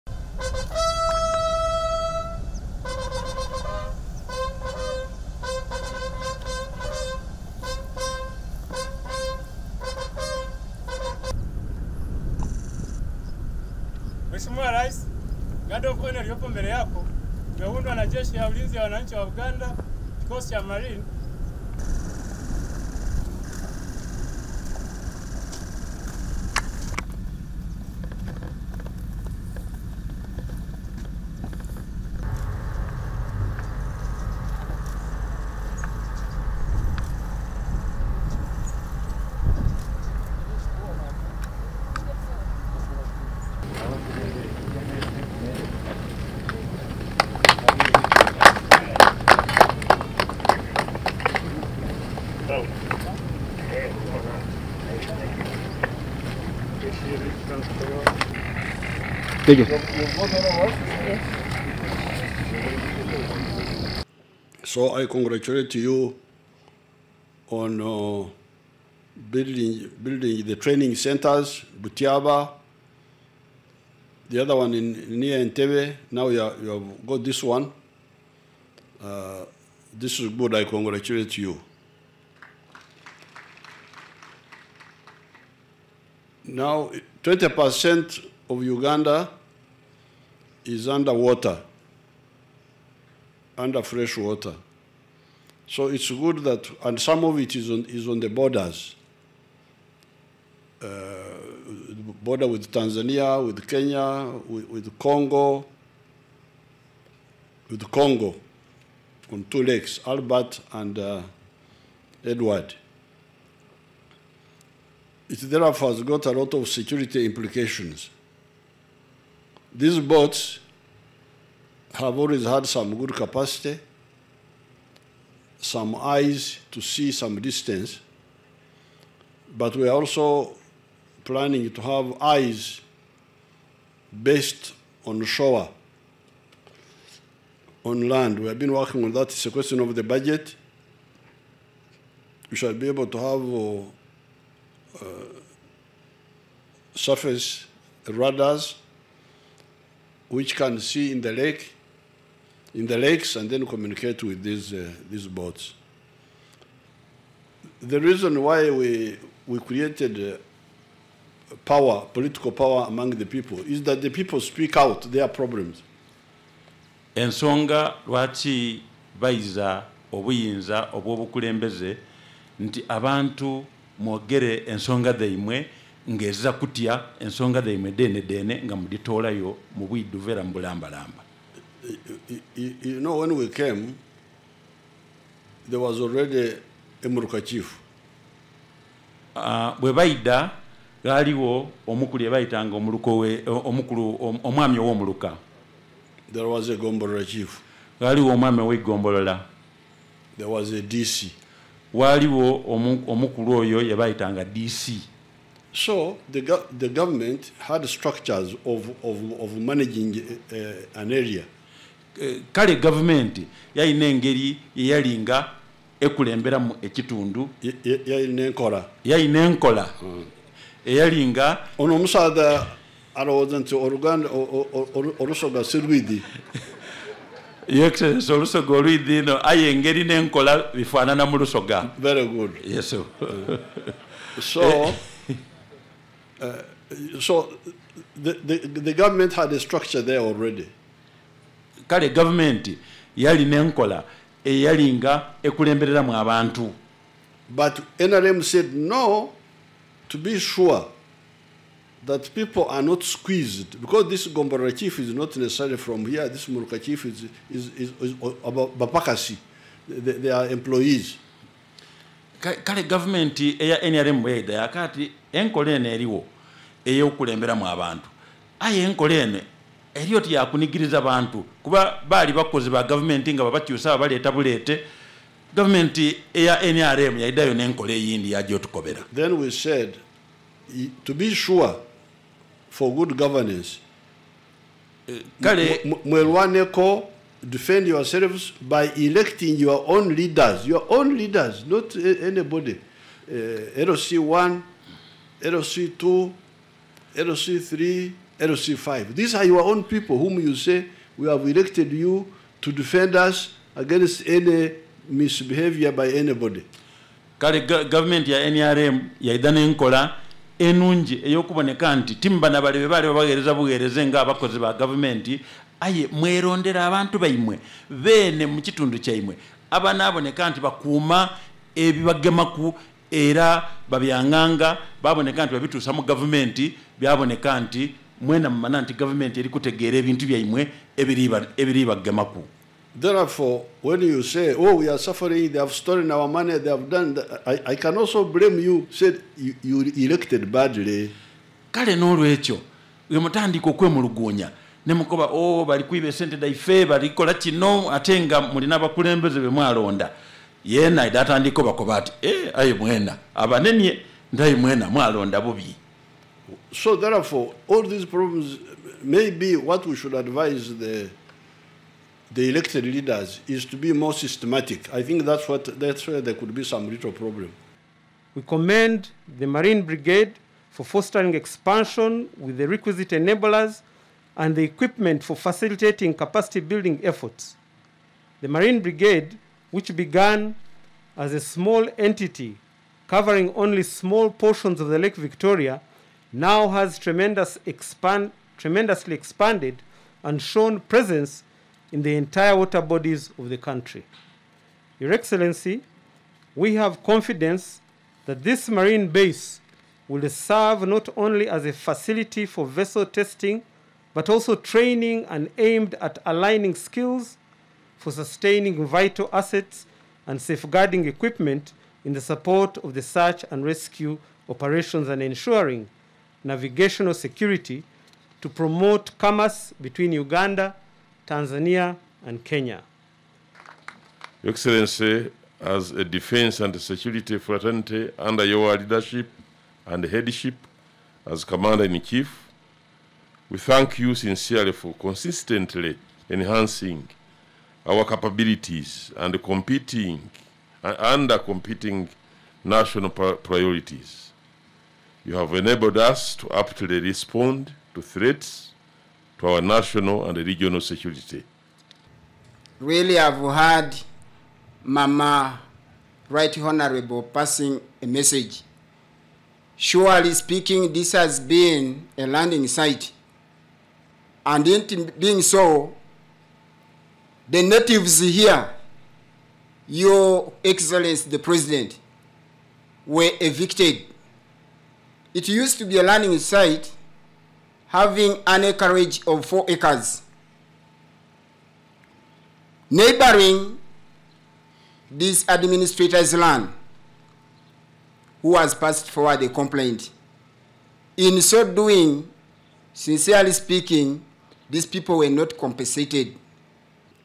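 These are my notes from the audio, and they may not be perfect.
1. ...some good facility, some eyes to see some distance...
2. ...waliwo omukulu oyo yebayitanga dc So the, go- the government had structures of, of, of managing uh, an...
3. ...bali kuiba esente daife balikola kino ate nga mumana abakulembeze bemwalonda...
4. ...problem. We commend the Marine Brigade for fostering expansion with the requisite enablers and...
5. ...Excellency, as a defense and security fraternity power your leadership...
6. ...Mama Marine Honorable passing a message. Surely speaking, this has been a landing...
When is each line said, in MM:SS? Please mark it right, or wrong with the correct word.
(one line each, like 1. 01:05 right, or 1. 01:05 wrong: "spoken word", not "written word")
1. 02:02 wrong: "capacity", not "facility"
2. 03:21 right
3. 05:45 wrong: "mulina", not "mumana"
4. 06:07 right
5. 07:04 wrong: "under", not "power"
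6. 07:34 wrong: "Right", not "Marine".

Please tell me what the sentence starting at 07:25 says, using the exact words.
You have enabled us to aptly respond to threats to our national and regional security.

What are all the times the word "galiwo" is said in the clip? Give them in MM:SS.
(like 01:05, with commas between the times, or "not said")
03:11, 03:18.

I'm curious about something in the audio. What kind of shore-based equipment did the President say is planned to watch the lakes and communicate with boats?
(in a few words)
Surface radars.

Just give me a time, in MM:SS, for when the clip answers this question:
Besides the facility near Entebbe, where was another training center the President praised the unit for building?
01:11.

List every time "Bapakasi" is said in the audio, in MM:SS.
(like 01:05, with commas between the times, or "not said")
04:18.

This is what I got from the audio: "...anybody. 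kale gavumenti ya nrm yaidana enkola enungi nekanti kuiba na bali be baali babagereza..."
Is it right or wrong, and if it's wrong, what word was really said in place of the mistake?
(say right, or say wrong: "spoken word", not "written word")
wrong: "timba", not "kuiba".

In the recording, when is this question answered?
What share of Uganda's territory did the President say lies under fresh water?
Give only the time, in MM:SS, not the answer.
01:27.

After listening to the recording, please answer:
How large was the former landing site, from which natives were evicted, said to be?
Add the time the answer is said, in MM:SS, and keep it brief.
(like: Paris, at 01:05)
4 acres, at 07:59.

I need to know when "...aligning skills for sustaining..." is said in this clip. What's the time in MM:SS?
06:46.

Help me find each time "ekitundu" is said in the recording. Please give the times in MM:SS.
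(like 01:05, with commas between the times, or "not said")
03:36.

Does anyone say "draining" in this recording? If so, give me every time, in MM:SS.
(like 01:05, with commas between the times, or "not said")
not said.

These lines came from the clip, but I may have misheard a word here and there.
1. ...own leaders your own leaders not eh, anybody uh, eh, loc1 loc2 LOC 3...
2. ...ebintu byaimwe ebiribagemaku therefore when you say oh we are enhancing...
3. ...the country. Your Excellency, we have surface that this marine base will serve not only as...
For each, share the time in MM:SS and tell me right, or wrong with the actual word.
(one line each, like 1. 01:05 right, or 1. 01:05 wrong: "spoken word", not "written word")
1. 04:49 right
2. 05:29 wrong: "suffering", not "enhancing"
3. 06:33 wrong: "confidence", not "surface".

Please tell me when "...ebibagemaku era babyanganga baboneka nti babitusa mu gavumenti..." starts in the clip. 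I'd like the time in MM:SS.
05:21.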